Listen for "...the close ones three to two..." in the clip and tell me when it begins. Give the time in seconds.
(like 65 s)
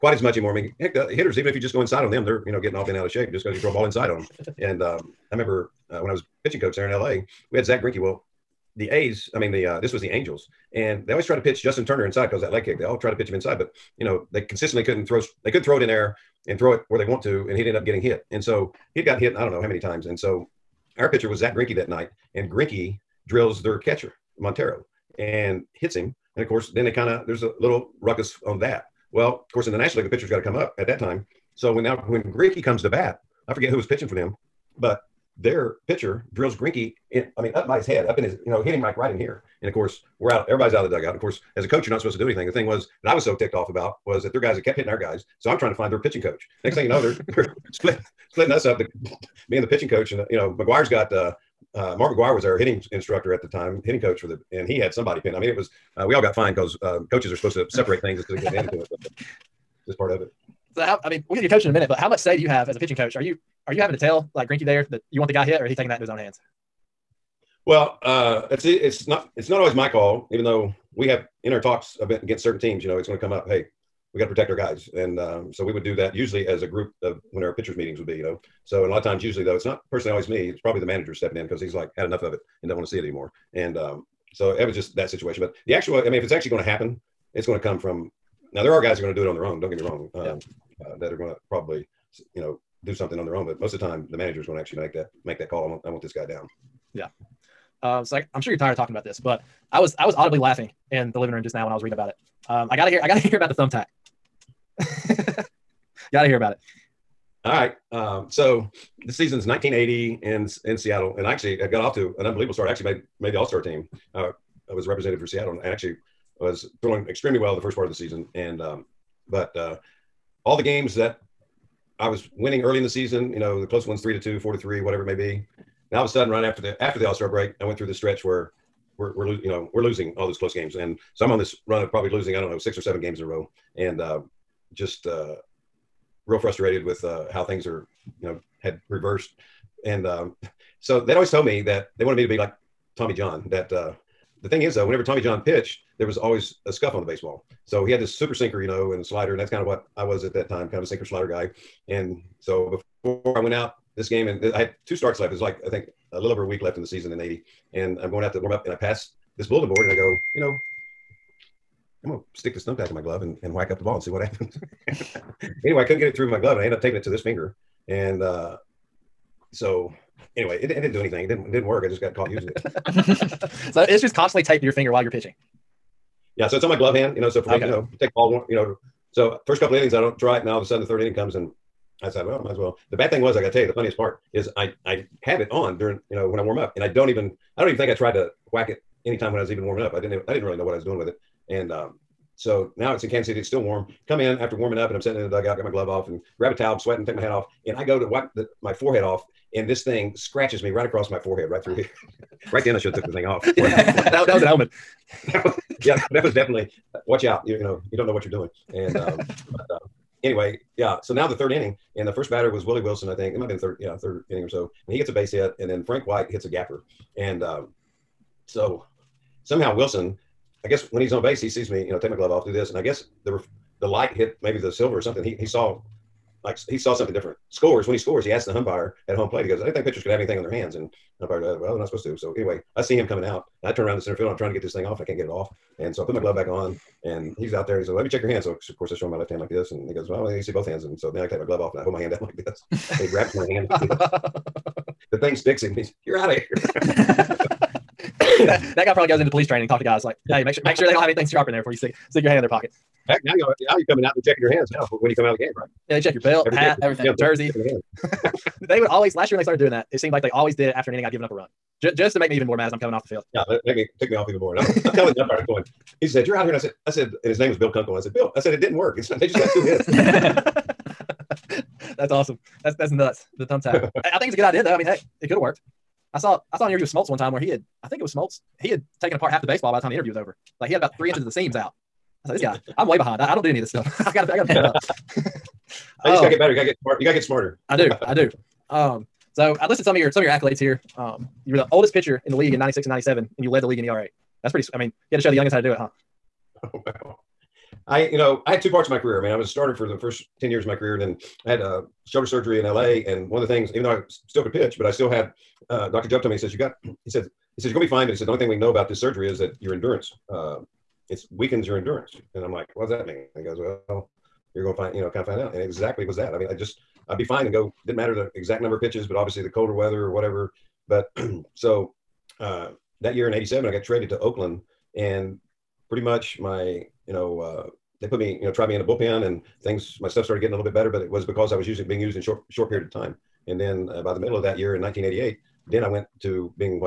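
123 s.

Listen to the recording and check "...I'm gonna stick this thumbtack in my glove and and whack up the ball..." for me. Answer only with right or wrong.
right.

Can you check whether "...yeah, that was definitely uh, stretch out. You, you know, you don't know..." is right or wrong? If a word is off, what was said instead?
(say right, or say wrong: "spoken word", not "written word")
wrong: "watch", not "stretch".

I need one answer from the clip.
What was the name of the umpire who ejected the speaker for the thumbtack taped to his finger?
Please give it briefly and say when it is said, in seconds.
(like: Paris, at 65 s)
Bill Kunkel, at 267 s.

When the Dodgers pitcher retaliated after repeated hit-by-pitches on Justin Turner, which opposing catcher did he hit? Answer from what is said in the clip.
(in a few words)
Montero.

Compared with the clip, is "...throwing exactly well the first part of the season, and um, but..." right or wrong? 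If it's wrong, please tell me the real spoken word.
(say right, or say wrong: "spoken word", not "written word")
wrong: "extremely", not "exactly".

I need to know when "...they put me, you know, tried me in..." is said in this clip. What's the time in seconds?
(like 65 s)
328 s.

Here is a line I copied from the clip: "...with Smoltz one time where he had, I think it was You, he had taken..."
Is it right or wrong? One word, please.
wrong.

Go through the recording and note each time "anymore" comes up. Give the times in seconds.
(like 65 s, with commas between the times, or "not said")
0 s, 83 s.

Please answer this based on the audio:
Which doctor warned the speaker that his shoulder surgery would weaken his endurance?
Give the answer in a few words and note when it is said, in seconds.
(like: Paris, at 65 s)
Dr. Jubb, at 305 s.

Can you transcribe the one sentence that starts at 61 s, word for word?
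I mean, we'll get to your coach in a minute, but how much say do you have as a pitching coach?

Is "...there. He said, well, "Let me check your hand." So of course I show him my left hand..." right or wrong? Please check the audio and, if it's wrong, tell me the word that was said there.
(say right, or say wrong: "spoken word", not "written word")
right.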